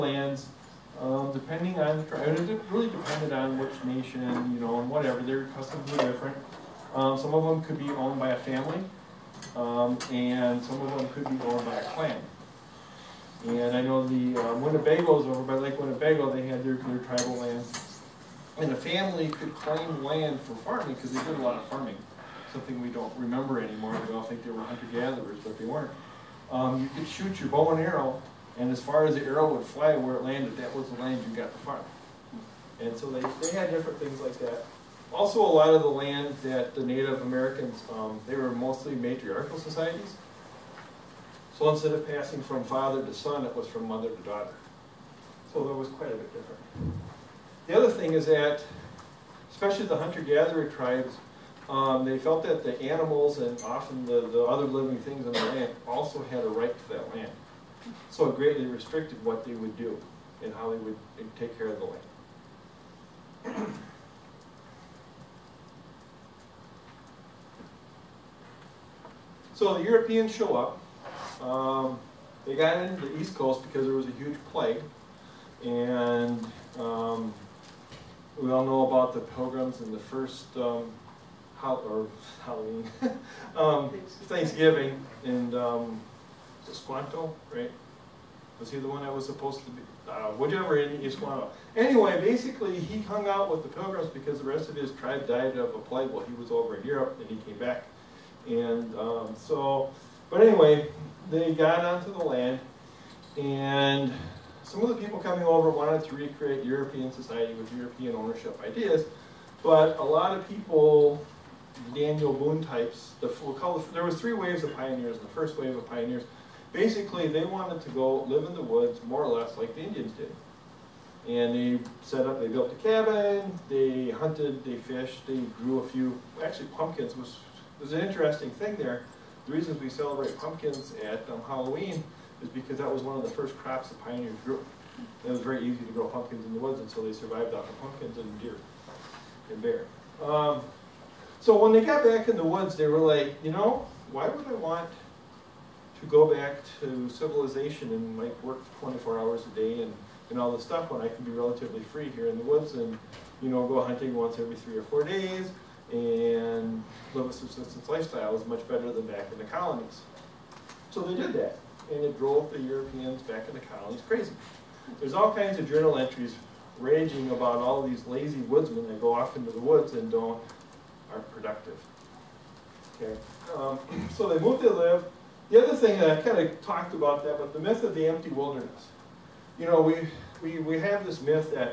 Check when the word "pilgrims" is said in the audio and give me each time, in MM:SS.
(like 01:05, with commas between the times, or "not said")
01:19, 01:33.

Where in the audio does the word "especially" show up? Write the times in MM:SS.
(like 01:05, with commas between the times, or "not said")
00:49.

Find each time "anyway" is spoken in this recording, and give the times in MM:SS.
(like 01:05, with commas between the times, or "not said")
01:31, 01:40.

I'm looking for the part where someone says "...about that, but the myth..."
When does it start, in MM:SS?
02:56.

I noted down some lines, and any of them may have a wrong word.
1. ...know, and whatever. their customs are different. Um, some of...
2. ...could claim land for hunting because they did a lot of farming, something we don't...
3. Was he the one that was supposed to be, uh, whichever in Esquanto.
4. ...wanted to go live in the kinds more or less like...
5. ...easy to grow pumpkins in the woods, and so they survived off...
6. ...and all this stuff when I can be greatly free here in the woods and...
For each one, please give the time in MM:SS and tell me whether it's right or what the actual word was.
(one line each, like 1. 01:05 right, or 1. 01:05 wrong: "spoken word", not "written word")
1. 00:04 right
2. 00:19 wrong: "farming", not "hunting"
3. 01:28 right
4. 01:57 wrong: "woods", not "kinds"
5. 02:15 right
6. 02:30 wrong: "relatively", not "greatly".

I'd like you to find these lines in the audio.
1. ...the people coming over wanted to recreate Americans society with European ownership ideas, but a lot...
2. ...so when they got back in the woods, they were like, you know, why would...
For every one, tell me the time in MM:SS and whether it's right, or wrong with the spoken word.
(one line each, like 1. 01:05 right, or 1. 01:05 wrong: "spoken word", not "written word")
1. 01:44 wrong: "European", not "Americans"
2. 02:21 right.